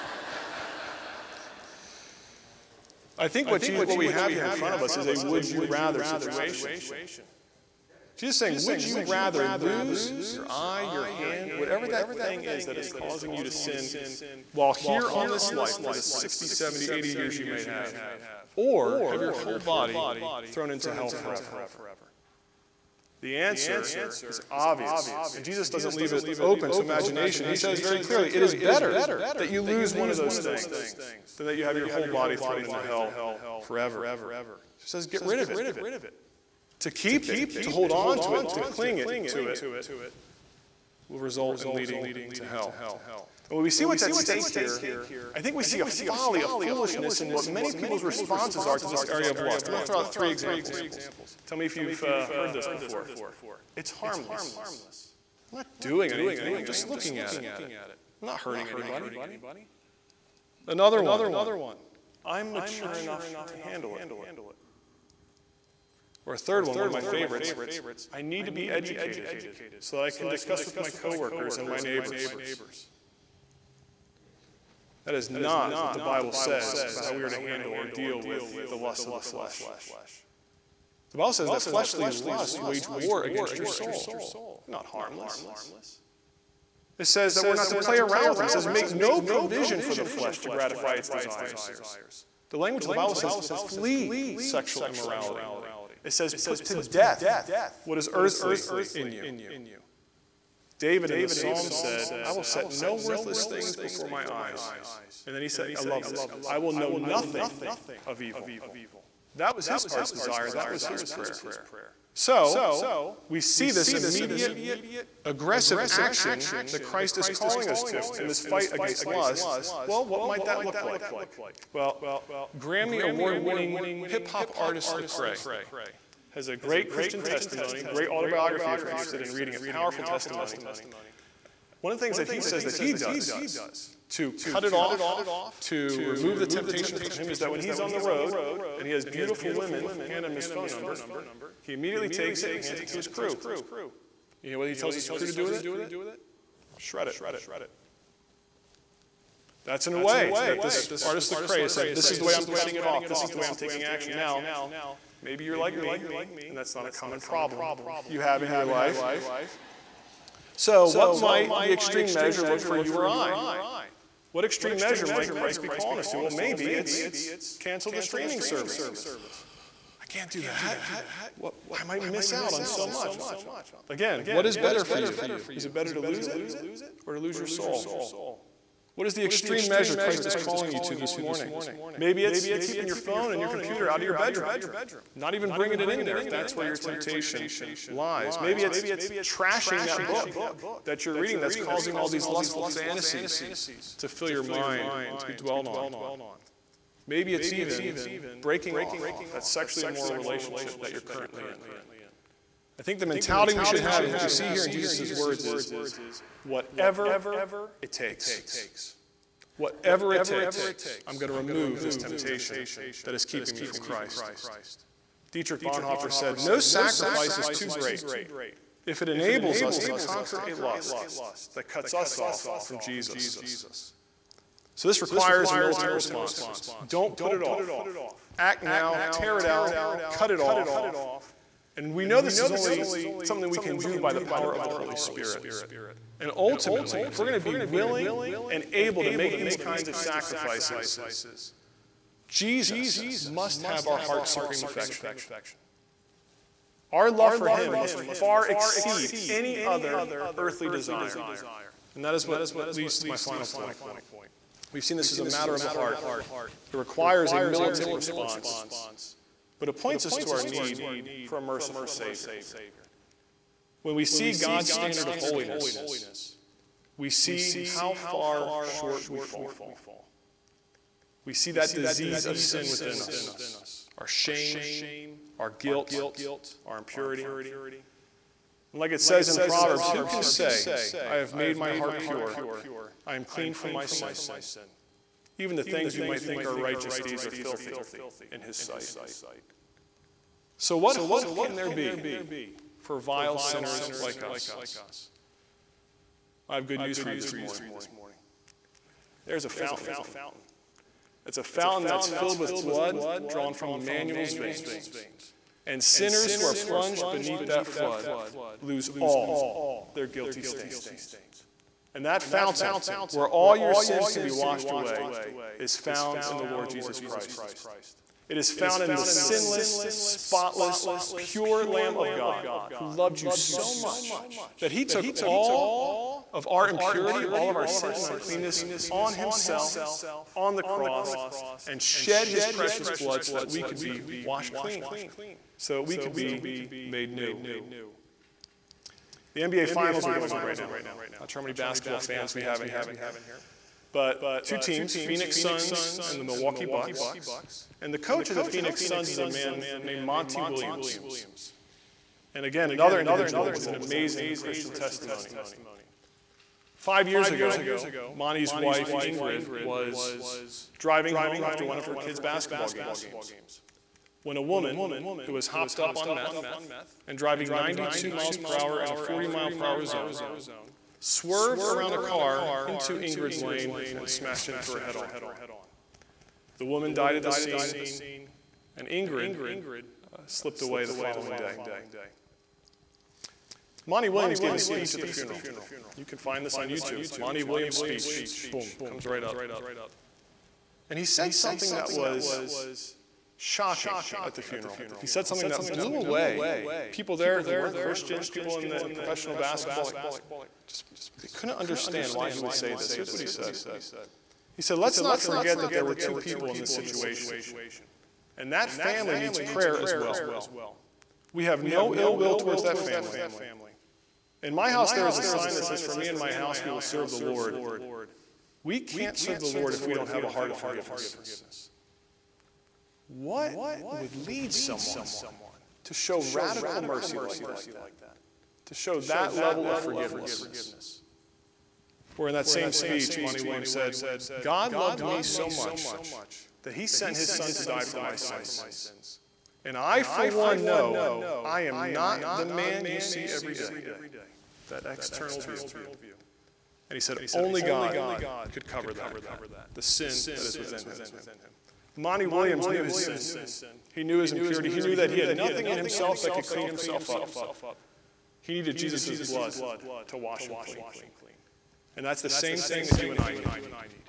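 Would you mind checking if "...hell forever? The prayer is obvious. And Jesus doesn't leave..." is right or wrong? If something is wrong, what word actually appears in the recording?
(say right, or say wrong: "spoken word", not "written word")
wrong: "answer", not "prayer".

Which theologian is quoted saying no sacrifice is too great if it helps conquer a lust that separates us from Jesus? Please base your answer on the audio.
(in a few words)
Dietrich Bonhoeffer.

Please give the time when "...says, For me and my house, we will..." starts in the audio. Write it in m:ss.
6:55.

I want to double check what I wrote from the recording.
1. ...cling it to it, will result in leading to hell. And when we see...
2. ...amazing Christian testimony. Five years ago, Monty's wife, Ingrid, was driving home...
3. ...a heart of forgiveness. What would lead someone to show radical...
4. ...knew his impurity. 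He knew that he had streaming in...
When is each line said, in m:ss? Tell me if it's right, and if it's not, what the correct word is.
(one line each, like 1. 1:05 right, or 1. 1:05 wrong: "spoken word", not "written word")
1. 0:38 right
2. 5:53 right
3. 7:00 right
4. 7:34 wrong: "nothing", not "streaming".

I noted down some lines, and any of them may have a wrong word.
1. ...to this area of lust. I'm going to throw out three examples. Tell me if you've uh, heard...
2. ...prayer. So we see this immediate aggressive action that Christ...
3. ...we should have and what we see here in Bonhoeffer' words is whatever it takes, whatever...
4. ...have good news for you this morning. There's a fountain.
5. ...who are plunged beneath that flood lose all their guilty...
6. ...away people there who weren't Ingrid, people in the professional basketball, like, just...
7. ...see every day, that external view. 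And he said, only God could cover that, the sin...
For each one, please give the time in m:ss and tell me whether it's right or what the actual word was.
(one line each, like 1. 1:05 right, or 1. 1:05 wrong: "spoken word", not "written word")
1. 0:48 right
2. 1:51 right
3. 3:23 wrong: "Jesus", not "Bonhoeffer"
4. 4:56 right
5. 5:06 right
6. 6:35 wrong: "Christians", not "Ingrid"
7. 7:23 right.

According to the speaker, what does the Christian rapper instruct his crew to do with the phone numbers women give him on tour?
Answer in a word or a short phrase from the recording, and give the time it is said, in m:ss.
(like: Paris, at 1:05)
Shred it, at 2:26.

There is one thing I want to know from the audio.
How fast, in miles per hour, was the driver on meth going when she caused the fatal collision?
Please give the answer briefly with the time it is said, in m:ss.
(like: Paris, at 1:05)
92, at 6:07.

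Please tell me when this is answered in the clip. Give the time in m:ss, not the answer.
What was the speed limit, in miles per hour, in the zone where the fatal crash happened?
6:08.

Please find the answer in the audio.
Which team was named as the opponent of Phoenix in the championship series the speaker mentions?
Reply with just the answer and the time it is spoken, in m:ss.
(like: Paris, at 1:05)
Milwaukee Bucks, at 5:46.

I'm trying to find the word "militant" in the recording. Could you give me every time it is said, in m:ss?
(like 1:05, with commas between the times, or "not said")
3:45, 4:17.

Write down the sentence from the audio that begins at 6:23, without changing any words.
Monty Williams gave a speech at the funeral.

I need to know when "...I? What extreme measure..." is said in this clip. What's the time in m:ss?
2:43.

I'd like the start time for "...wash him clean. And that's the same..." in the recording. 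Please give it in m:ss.
7:40.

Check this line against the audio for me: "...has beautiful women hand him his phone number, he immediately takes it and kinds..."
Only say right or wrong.
wrong.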